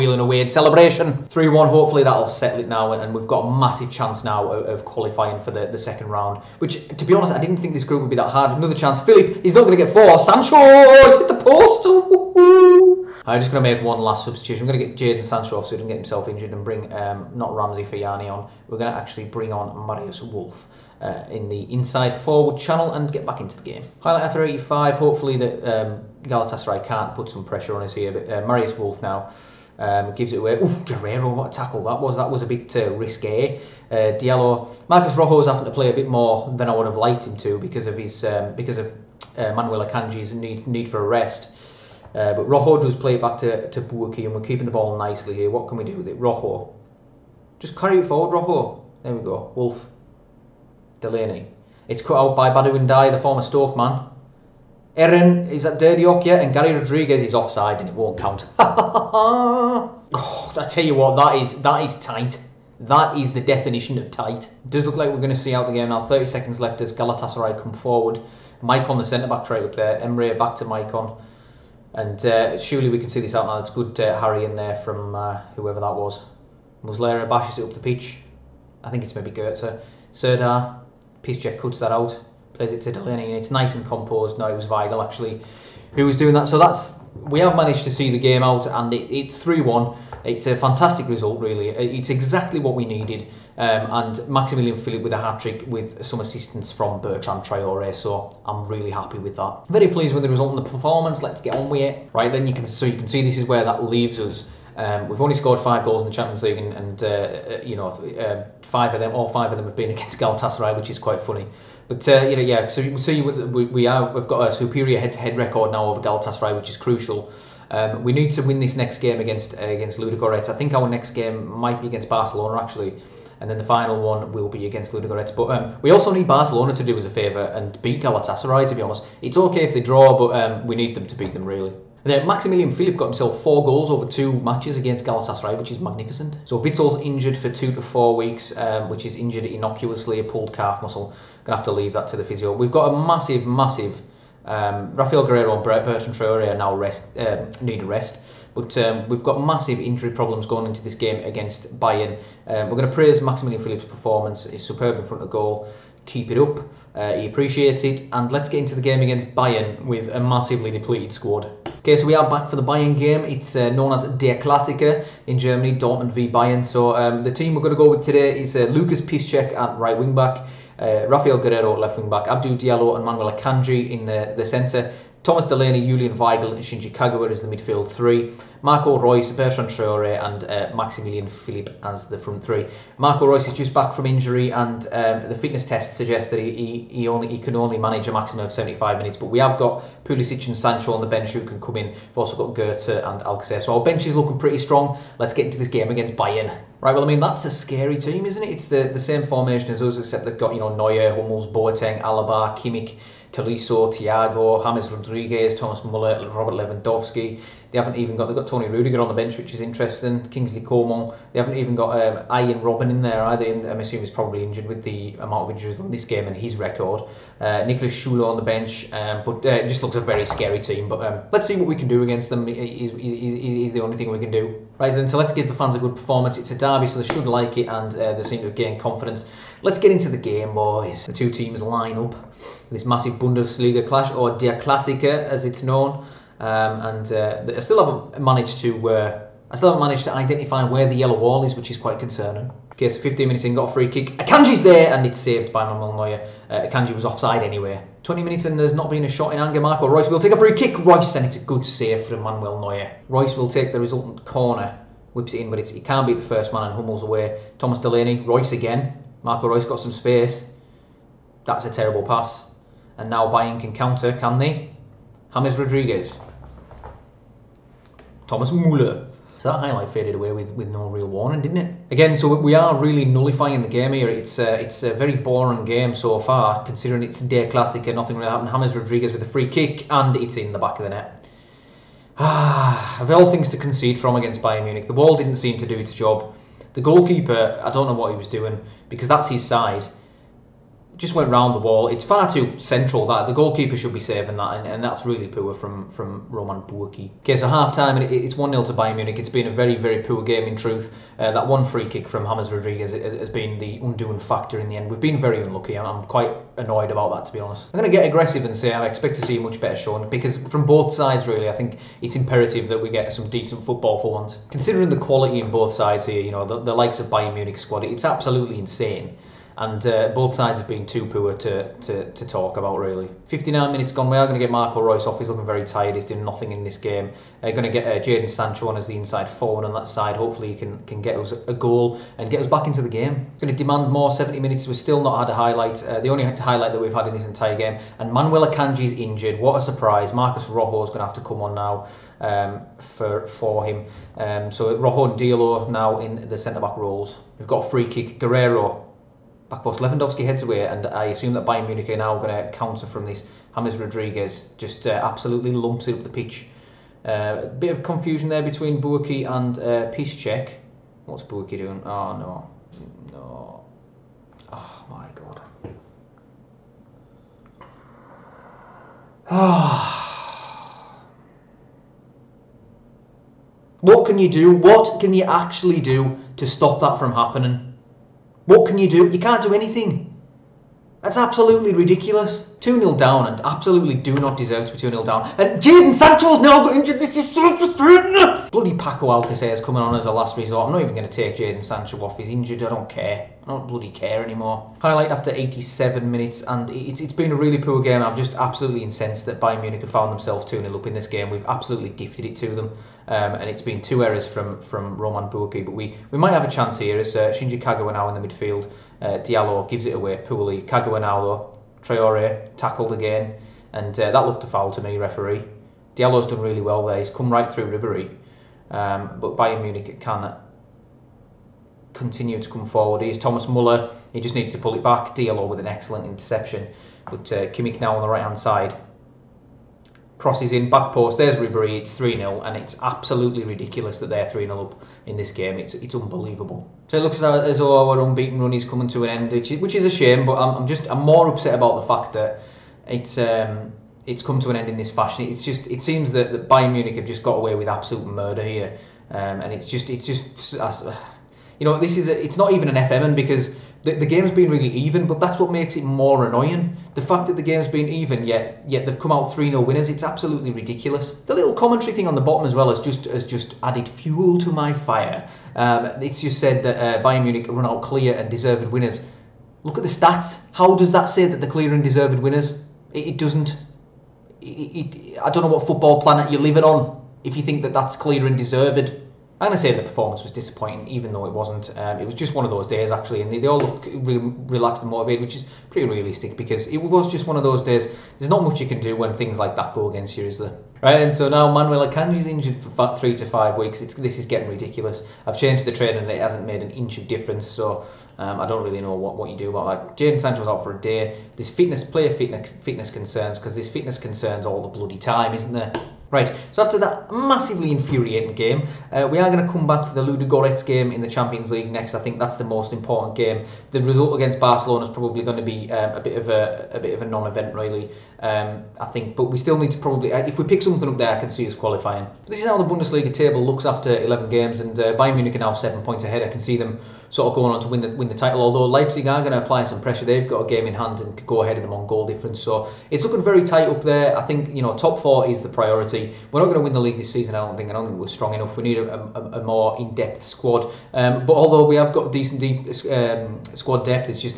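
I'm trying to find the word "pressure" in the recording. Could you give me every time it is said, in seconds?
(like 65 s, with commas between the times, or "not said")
27 s, 529 s.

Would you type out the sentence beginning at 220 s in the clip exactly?
But um, let's see what we can do against them.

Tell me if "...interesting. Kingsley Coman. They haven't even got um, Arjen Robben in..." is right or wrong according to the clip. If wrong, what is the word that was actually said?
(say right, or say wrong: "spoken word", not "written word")
right.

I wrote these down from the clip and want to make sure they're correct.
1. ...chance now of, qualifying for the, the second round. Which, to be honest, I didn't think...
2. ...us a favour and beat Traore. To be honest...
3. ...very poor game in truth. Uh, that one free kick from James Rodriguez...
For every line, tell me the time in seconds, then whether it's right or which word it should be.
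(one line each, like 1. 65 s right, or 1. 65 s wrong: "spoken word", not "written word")
1. 3 s right
2. 126 s wrong: "Galatasaray", not "Traore"
3. 299 s right.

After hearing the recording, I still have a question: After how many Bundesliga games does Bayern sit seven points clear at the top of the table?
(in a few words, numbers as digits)
11.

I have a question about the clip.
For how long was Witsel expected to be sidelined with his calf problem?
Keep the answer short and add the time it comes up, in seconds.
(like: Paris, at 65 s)
two to four weeks, at 137 s.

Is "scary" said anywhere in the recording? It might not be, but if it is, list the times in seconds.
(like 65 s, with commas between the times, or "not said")
197 s, 220 s.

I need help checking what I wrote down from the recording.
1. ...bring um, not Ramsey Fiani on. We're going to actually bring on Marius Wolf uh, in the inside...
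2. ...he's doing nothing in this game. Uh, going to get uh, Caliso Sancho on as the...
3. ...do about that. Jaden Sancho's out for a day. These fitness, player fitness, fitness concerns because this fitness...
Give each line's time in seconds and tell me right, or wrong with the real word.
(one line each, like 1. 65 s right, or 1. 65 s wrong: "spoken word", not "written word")
1. 16 s right
2. 325 s wrong: "Jaden", not "Caliso"
3. 499 s right.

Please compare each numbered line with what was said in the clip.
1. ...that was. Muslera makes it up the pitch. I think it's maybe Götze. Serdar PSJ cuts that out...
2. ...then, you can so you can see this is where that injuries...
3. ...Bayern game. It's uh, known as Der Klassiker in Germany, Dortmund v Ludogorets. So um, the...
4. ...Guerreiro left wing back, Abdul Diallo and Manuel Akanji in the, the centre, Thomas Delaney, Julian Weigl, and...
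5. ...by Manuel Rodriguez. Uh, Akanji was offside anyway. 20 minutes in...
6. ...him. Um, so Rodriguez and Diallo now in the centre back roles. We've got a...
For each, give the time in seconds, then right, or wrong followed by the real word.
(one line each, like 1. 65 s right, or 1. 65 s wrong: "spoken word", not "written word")
1. 75 s wrong: "bashes", not "makes"
2. 102 s wrong: "leaves", not "injuries"
3. 162 s wrong: "Bayern", not "Ludogorets"
4. 171 s right
5. 245 s wrong: "Neuer", not "Rodriguez"
6. 343 s wrong: "Rojo", not "Rodriguez".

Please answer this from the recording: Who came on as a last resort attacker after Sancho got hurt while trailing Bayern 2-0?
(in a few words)
Paco Alcacer.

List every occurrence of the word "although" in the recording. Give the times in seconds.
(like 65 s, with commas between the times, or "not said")
528 s, 541 s.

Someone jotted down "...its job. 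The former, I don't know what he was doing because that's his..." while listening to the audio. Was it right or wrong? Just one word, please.
wrong.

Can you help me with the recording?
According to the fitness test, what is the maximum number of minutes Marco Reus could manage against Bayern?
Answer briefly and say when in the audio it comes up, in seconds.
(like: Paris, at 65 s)
75, at 188 s.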